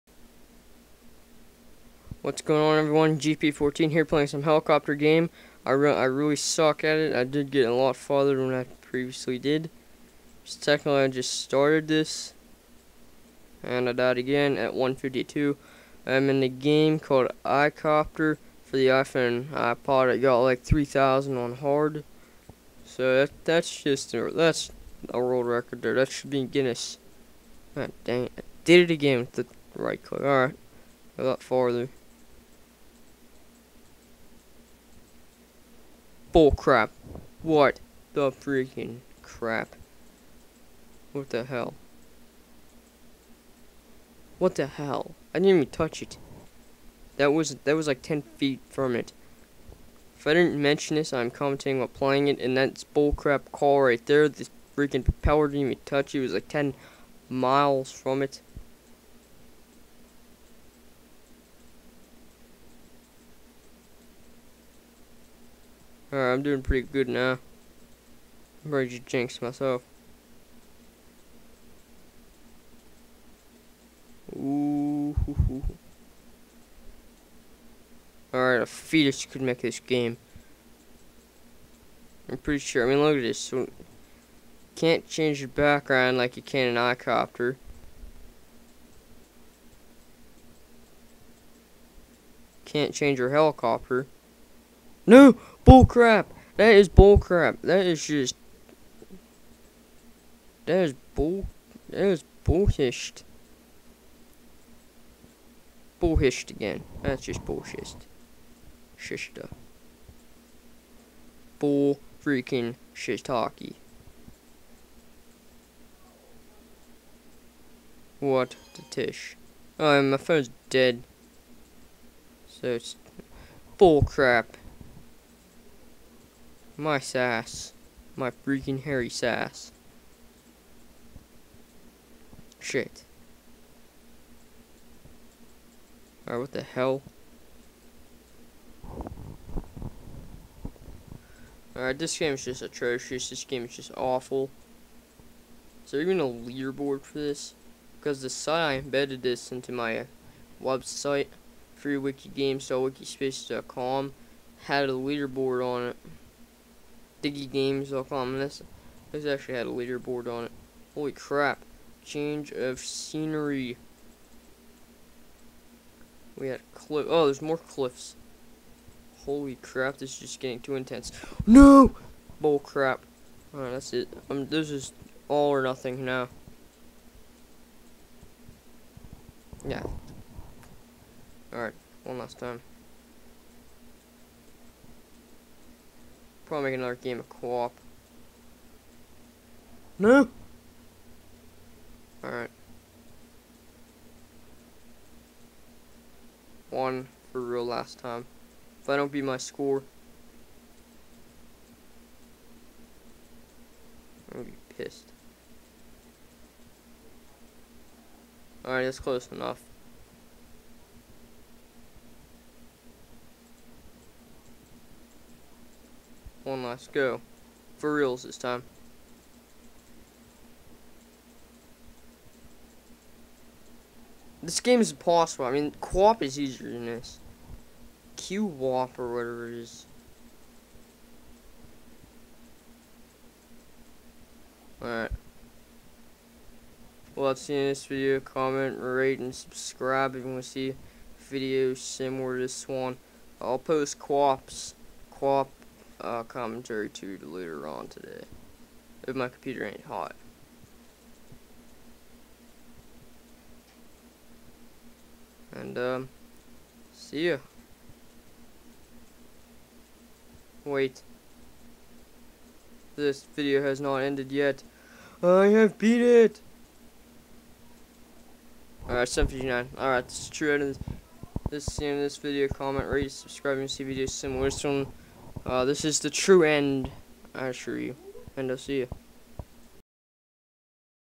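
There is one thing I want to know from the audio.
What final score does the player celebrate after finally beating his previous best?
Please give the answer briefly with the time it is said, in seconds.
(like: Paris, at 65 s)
759, at 269 s.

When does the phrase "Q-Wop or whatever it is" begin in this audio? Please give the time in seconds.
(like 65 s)
228 s.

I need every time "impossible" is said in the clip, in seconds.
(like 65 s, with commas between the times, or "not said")
224 s.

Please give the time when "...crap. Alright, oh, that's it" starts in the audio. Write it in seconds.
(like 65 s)
172 s.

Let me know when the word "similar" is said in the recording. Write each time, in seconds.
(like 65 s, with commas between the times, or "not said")
241 s, 274 s.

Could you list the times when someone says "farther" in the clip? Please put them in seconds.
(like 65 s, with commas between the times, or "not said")
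7 s, 31 s.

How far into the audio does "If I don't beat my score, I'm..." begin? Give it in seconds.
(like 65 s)
198 s.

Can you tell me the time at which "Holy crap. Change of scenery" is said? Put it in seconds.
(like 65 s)
160 s.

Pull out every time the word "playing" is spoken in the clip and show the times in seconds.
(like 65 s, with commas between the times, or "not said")
4 s, 51 s.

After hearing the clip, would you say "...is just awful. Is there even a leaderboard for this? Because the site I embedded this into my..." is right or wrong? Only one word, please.
right.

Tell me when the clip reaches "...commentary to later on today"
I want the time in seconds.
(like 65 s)
246 s.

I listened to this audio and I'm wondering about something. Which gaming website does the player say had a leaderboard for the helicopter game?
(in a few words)
diggygames.com.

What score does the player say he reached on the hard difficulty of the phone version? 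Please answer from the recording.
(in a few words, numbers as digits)
3,000.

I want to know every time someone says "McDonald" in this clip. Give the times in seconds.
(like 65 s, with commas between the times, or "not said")
not said.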